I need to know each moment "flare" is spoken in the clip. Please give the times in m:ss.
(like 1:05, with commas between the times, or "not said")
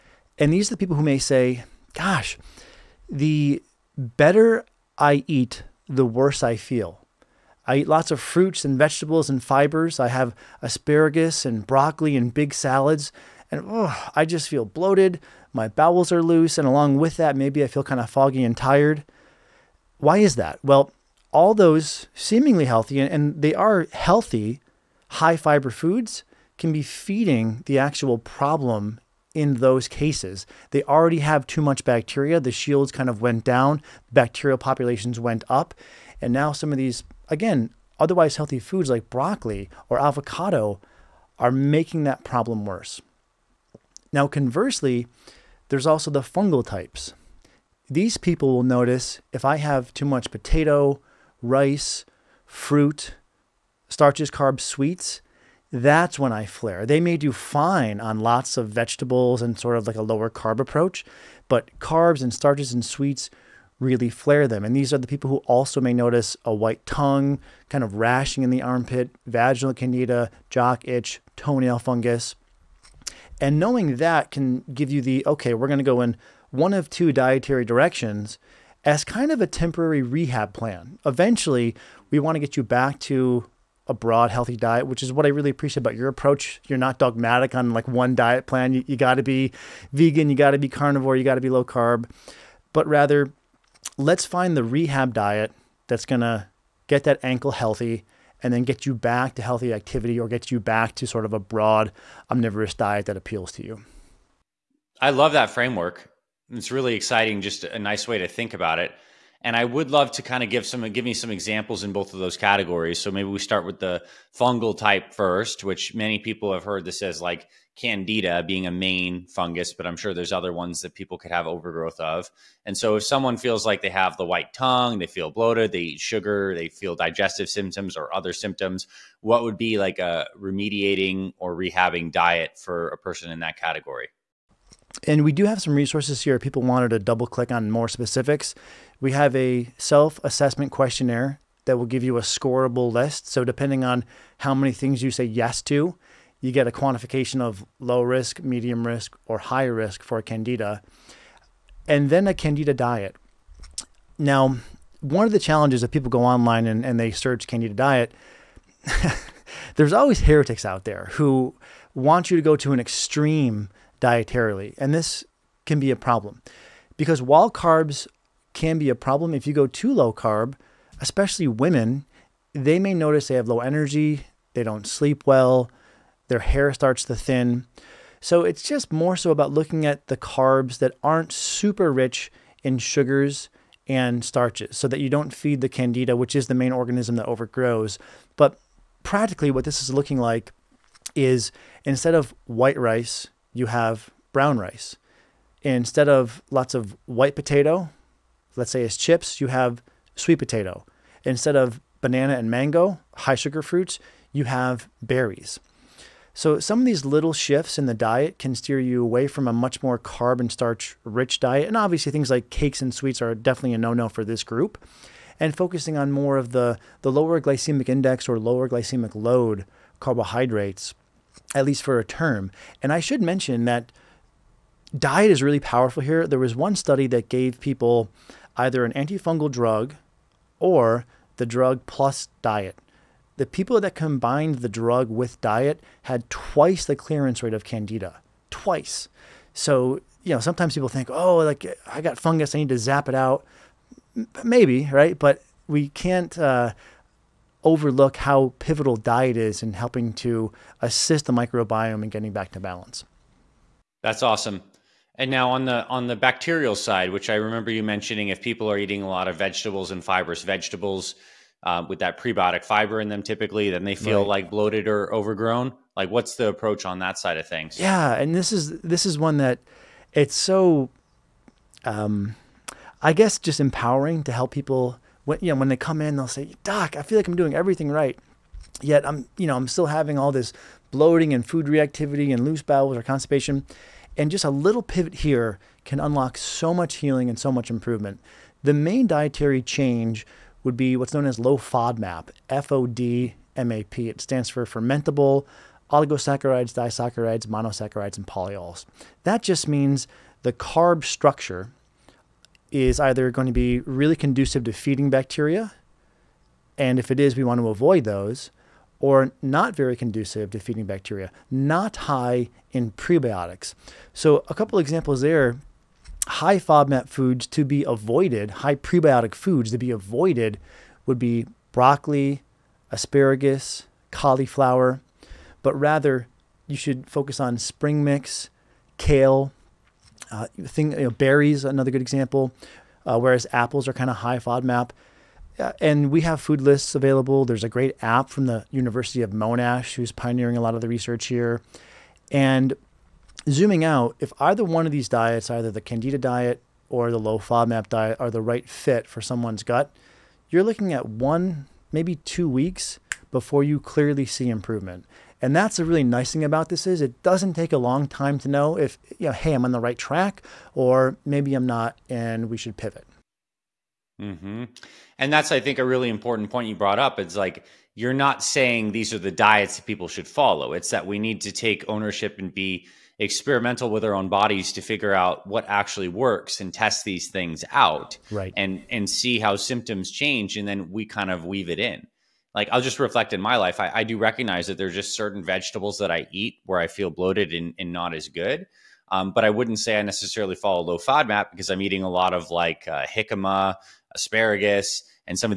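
0:56, 1:04.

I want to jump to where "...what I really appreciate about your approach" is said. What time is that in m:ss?
1:25.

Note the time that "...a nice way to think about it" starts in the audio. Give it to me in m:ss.
1:47.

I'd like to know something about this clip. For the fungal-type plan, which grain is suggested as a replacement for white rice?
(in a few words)
Brown rice.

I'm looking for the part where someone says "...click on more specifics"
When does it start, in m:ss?
2:17.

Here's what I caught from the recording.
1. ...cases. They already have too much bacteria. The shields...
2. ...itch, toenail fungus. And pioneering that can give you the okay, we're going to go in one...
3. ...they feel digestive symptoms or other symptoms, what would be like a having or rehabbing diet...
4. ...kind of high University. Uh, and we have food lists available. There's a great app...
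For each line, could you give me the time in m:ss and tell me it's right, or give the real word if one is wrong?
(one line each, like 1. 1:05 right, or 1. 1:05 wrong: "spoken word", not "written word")
1. 0:29 right
2. 1:10 wrong: "knowing", not "pioneering"
3. 2:06 wrong: "remediating", not "having"
4. 5:33 wrong: "FODMAP", not "University".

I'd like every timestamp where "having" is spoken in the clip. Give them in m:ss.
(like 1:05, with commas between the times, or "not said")
4:39.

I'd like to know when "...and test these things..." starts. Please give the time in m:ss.
6:16.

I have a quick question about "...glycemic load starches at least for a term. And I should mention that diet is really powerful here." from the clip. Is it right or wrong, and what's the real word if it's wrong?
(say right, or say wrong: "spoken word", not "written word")
wrong: "carbohydrates", not "starches".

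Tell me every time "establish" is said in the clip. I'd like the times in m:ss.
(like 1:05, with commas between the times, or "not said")
not said.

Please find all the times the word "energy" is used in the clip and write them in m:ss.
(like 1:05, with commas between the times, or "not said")
2:53.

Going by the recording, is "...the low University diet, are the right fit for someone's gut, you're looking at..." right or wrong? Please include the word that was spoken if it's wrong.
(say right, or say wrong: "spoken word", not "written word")
wrong: "FODMAP", not "University".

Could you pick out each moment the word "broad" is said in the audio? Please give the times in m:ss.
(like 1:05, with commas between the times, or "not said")
1:23, 1:41.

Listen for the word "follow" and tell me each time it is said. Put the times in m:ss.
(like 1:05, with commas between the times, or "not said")
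6:10, 6:30.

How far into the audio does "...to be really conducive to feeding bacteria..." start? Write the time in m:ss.
5:03.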